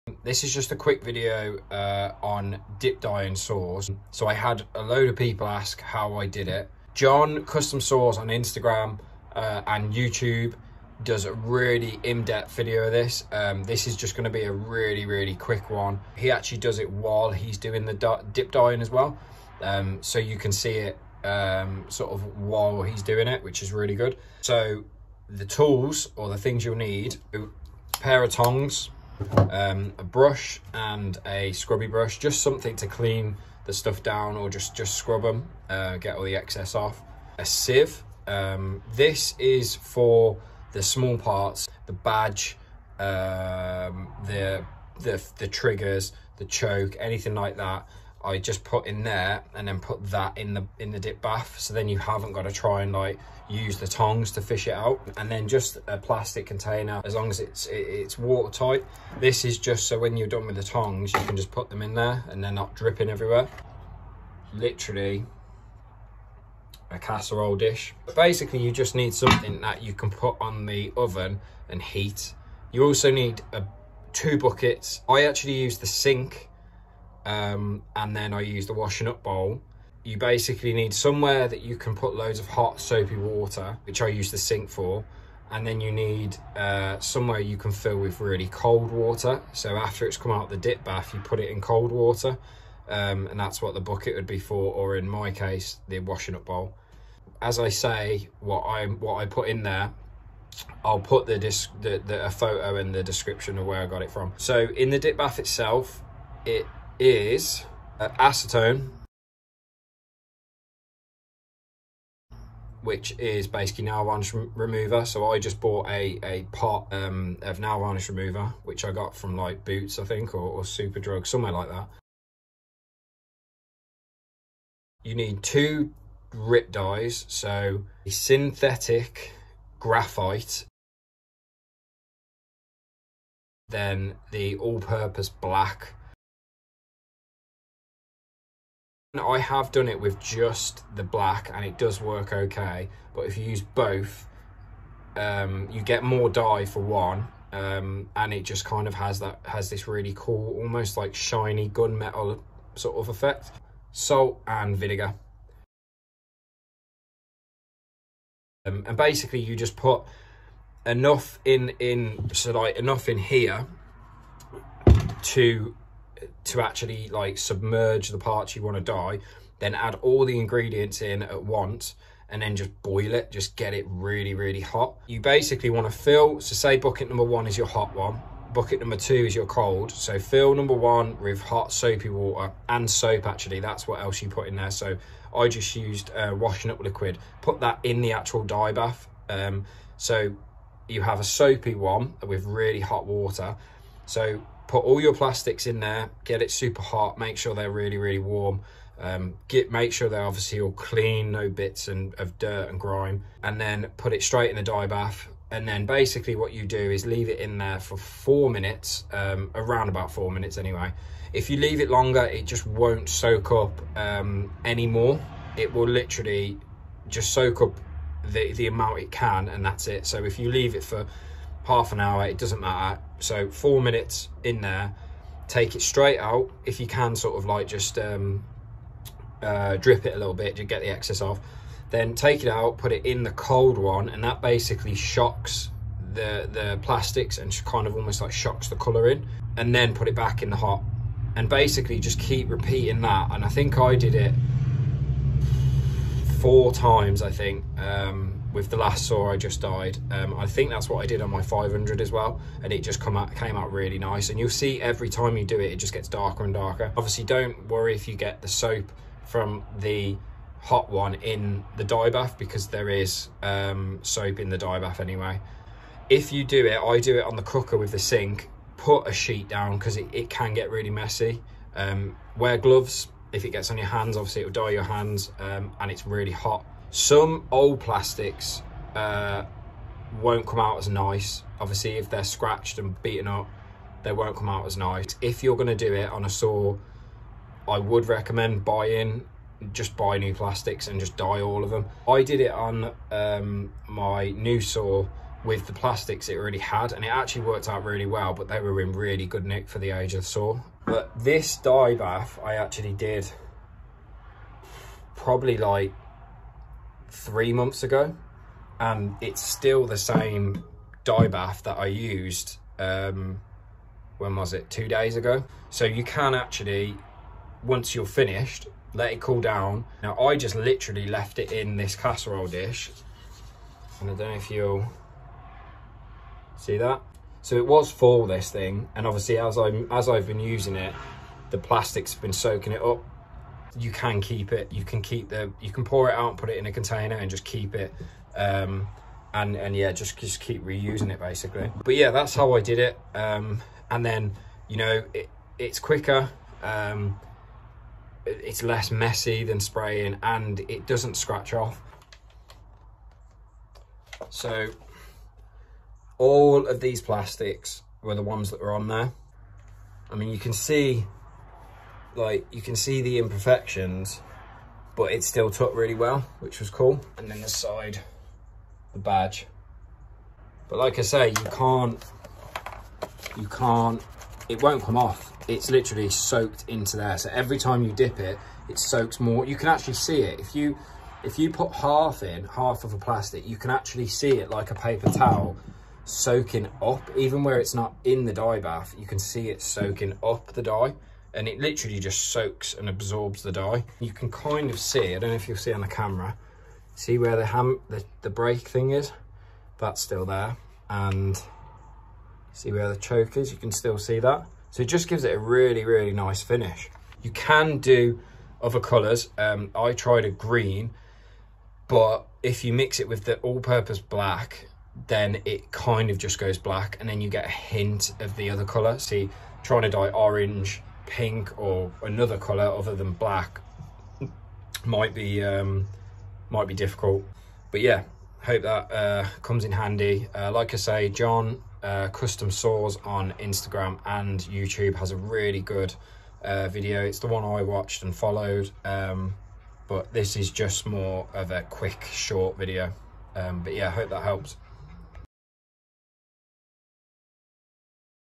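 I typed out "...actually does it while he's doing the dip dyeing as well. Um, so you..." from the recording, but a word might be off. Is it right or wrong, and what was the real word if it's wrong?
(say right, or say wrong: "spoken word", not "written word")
right.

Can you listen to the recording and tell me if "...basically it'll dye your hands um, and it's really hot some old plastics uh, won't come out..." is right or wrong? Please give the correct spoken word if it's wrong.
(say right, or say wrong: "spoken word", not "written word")
wrong: "obviously", not "basically".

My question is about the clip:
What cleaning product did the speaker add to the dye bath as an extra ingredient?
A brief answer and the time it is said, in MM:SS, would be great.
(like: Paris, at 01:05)
Washing up liquid, at 03:06.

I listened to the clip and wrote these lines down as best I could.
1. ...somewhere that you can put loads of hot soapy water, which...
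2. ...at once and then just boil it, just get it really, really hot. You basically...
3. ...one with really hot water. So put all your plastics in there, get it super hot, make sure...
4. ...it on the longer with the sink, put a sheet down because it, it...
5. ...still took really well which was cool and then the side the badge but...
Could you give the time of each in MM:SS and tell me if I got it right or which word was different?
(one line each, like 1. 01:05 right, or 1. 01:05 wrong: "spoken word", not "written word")
1. 01:20 right
2. 02:51 right
3. 03:11 right
4. 04:27 wrong: "cooker", not "longer"
5. 06:05 right.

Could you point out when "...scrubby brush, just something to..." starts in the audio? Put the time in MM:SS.
00:31.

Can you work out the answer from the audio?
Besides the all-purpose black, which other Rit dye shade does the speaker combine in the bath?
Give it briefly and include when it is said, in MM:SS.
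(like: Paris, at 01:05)
Synthetic graphite, at 02:08.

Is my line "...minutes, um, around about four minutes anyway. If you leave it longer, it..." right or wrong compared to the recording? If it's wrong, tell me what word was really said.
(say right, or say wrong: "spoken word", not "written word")
right.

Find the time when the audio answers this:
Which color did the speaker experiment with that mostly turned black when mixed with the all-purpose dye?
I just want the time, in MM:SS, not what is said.
06:50.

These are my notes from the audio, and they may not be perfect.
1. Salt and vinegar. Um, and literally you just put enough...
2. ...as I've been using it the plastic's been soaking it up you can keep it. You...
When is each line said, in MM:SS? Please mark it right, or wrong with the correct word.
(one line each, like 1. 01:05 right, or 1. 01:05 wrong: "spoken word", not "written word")
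1. 02:33 wrong: "basically", not "literally"
2. 05:29 right.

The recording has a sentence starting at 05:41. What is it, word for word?
But yeah, that's how I did it.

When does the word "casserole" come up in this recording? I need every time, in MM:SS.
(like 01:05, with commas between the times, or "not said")
01:06, 05:21.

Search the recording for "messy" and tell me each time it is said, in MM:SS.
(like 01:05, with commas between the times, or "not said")
04:30, 05:48.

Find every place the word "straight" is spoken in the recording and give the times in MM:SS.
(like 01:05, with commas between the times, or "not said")
03:24, 03:45.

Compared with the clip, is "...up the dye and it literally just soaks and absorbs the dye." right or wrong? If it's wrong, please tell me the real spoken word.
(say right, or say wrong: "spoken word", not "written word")
right.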